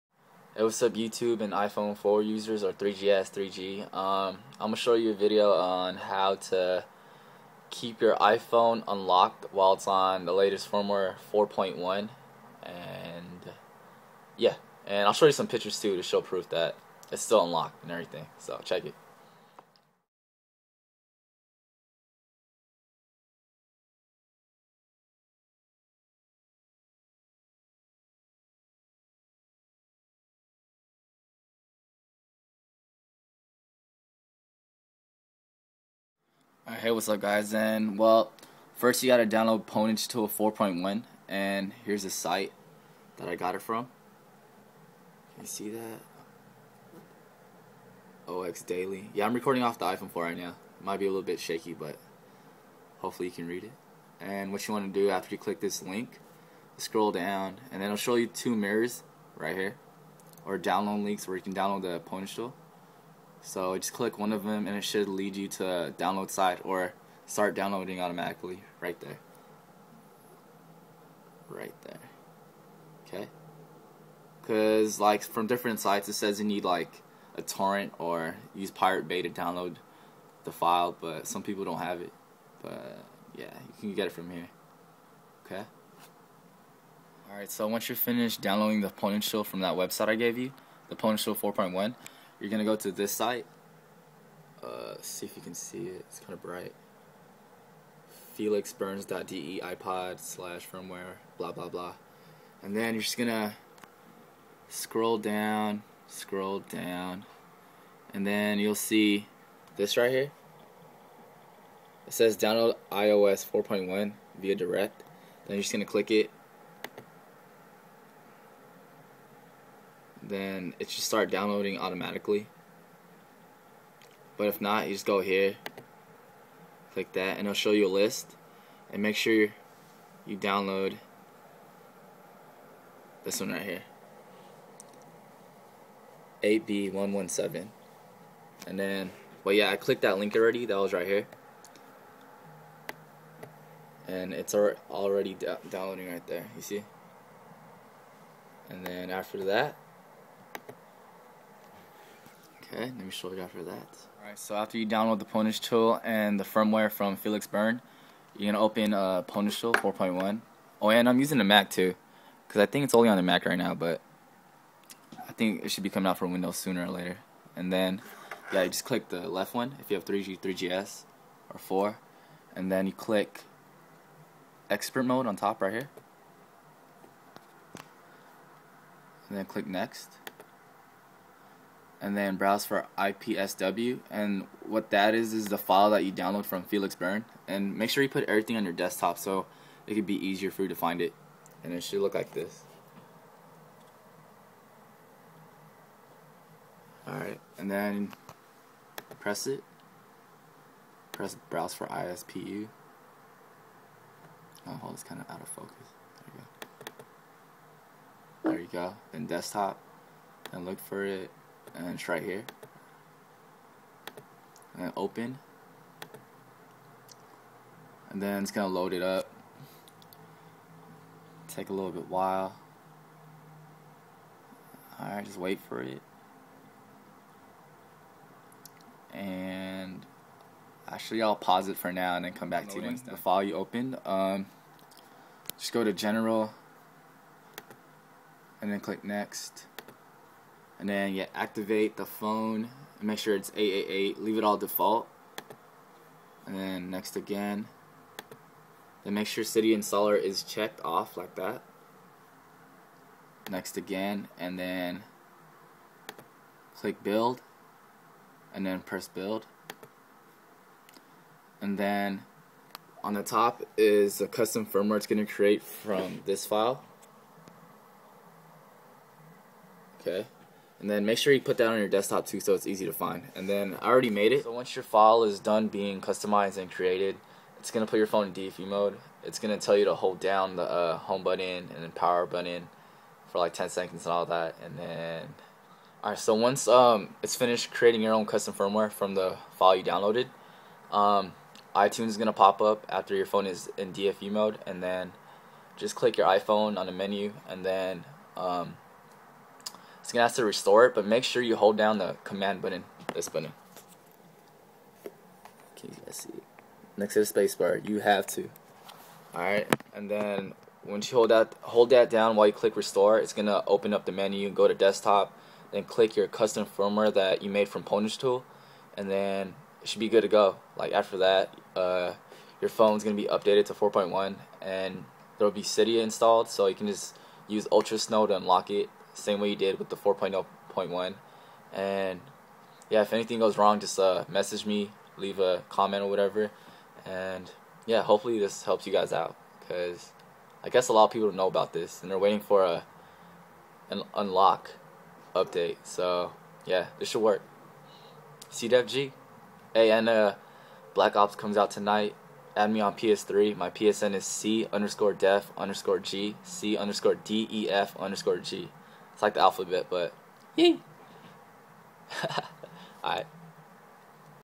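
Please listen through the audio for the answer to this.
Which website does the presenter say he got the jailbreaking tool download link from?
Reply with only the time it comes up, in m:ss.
0:48.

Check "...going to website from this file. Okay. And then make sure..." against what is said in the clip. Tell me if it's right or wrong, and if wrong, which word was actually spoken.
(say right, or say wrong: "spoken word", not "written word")
wrong: "create", not "website".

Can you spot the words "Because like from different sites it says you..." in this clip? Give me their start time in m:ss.
1:14.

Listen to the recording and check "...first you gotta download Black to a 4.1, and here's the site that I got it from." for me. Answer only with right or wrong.
wrong.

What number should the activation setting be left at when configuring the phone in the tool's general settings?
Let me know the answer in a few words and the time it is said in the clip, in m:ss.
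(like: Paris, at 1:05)
888, at 4:03.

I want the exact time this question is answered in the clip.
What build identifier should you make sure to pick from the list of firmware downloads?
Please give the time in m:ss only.
2:16.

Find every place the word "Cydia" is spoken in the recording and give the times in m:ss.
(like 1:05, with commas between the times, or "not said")
4:09, 5:25.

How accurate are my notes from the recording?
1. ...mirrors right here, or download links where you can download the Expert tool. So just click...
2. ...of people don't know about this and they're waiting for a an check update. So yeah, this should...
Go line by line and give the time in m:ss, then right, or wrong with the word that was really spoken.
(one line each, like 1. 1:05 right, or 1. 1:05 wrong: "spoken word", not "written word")
1. 0:58 wrong: "Pwnage", not "Expert"
2. 5:41 wrong: "unlock", not "check".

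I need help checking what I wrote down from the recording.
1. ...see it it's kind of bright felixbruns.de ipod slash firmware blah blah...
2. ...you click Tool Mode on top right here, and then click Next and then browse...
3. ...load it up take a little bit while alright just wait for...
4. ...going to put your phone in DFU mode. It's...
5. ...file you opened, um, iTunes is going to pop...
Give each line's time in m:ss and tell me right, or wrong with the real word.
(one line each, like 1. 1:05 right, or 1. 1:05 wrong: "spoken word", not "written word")
1. 1:35 right
2. 2:52 wrong: "Expert", not "Tool"
3. 3:38 right
4. 4:37 right
5. 4:49 wrong: "downloaded", not "opened".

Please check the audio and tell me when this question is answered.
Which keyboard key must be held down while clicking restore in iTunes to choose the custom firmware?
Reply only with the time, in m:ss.
5:02.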